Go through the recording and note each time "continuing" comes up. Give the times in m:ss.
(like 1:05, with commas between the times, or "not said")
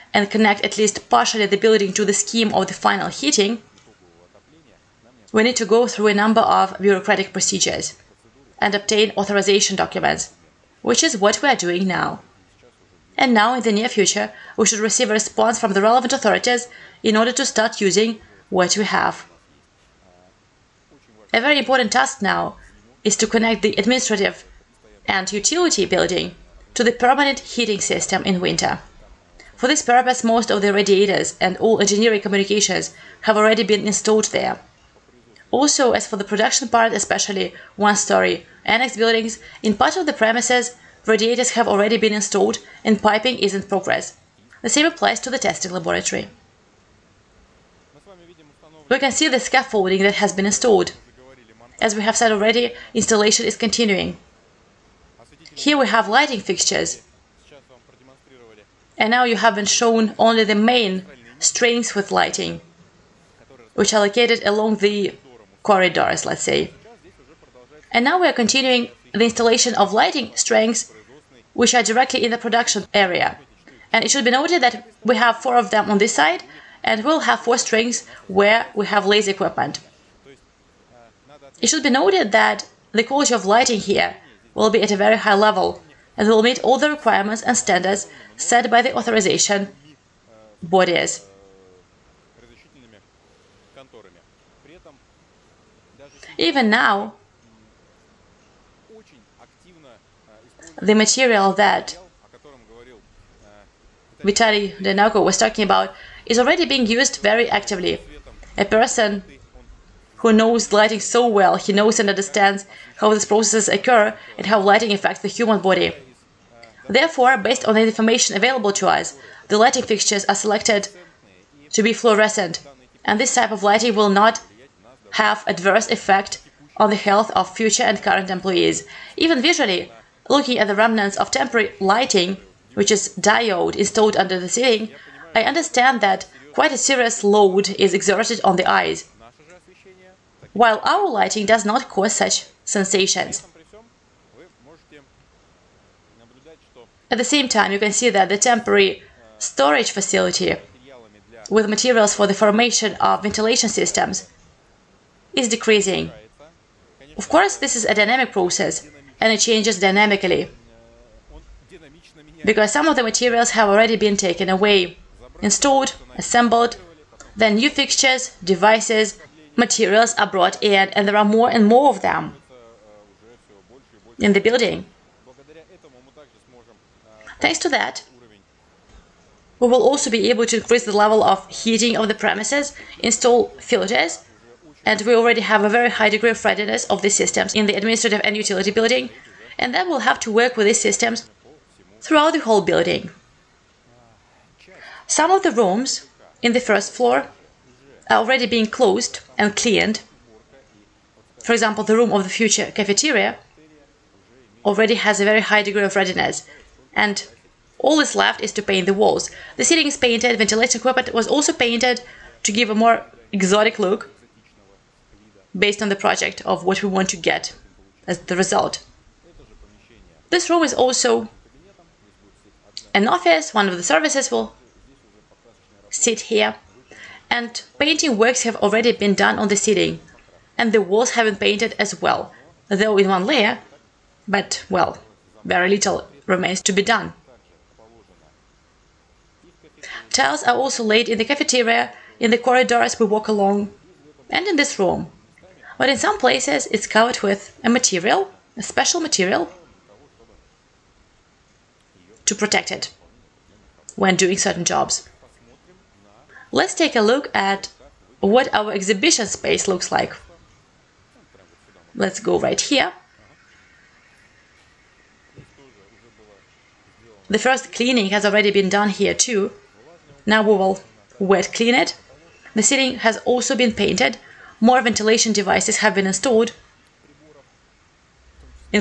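0:53, 1:08.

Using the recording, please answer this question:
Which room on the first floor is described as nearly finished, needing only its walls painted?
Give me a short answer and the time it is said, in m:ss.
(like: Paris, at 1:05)
The cafeteria, at 3:22.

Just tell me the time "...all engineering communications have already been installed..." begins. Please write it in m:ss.
0:31.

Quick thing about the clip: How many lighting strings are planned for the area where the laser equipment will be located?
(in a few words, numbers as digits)
4.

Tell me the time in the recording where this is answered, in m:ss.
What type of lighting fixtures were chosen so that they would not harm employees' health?
2:01.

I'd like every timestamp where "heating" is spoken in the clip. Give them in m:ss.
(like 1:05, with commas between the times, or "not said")
0:03, 0:27, 3:01.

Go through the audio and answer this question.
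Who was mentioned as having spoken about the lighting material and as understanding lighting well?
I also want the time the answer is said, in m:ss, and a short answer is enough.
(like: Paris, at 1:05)
Vitaly Denako, at 1:44.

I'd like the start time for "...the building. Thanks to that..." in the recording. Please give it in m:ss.
2:54.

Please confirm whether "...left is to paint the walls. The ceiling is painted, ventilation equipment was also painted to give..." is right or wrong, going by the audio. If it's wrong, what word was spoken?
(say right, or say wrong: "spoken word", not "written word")
right.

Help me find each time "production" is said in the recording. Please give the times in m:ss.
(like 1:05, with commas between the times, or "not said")
0:36, 1:12.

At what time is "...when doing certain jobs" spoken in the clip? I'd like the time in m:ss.
4:13.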